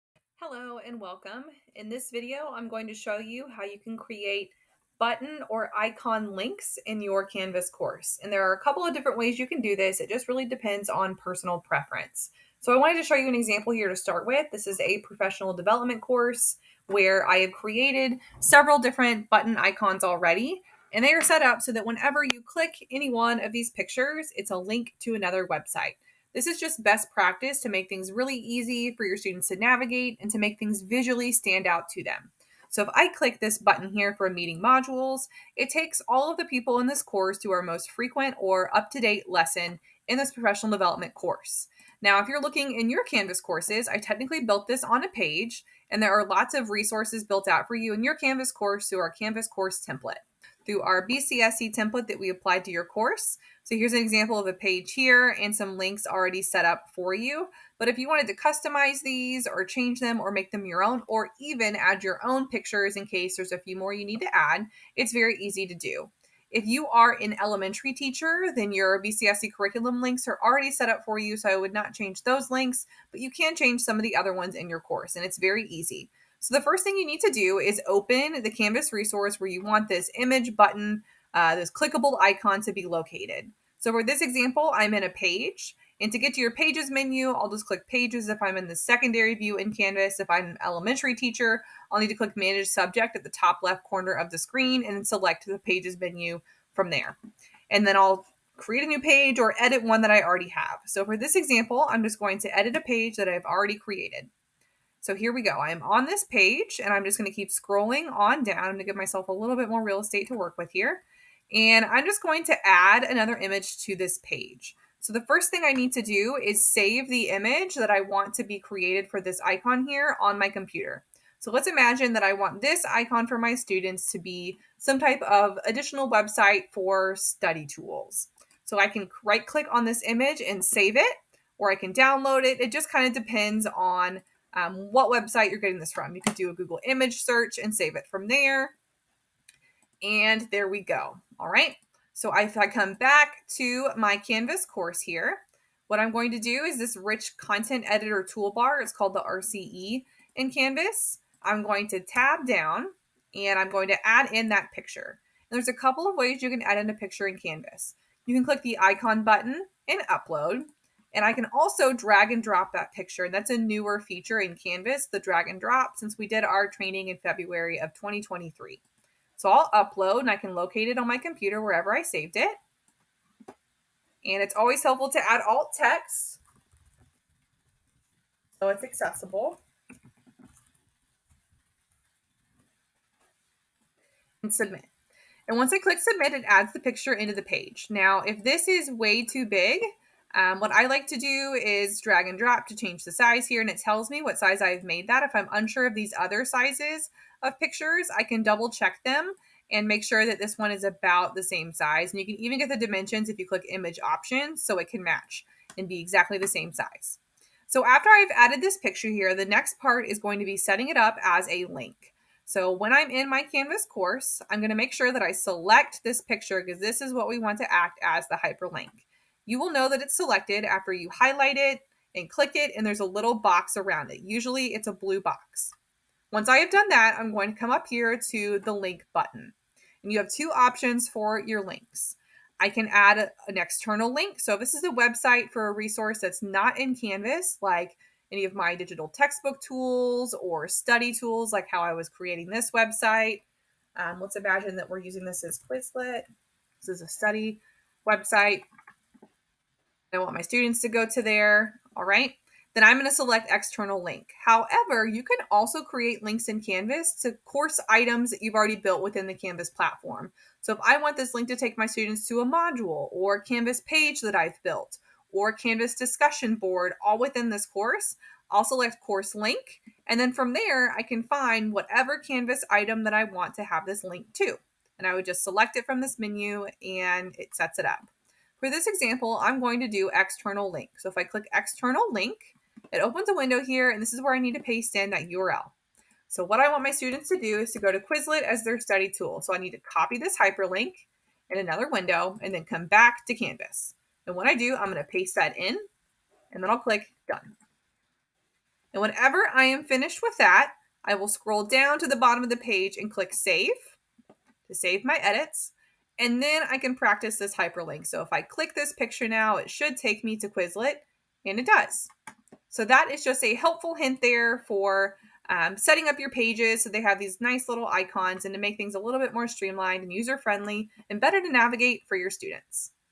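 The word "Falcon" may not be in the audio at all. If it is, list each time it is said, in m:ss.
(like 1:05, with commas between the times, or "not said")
not said.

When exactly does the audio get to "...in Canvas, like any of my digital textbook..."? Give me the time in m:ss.
3:56.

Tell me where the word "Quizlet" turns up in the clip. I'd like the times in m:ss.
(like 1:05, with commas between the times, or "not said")
4:05, 4:47, 5:10.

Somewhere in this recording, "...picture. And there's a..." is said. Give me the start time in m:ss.
2:34.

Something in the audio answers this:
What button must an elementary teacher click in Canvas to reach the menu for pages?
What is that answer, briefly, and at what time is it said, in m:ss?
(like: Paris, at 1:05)
Manage subject, at 1:32.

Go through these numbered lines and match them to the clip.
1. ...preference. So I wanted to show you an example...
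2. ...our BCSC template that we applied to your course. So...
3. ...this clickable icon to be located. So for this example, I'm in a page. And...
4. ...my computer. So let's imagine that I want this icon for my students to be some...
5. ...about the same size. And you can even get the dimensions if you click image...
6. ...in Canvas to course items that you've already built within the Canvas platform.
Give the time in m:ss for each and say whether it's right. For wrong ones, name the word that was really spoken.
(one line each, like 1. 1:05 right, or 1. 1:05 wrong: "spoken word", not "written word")
1. 0:11 right
2. 0:50 right
3. 1:21 right
4. 2:00 right
5. 3:20 right
6. 4:16 right.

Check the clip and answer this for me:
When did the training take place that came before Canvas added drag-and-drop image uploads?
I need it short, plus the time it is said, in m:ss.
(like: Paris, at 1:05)
February 2023, at 2:47.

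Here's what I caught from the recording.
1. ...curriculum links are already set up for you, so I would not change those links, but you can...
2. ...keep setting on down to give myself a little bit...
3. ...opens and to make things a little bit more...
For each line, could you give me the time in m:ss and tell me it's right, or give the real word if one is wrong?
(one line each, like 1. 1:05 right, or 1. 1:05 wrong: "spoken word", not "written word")
1. 1:09 right
2. 1:47 wrong: "scrolling", not "setting"
3. 5:17 wrong: "icons", not "opens".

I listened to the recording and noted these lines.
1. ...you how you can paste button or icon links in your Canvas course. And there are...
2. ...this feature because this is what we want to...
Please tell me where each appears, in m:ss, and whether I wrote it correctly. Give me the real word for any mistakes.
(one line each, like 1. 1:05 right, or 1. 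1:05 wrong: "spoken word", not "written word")
1. 0:03 wrong: "create", not "paste"
2. 3:36 wrong: "picture", not "feature".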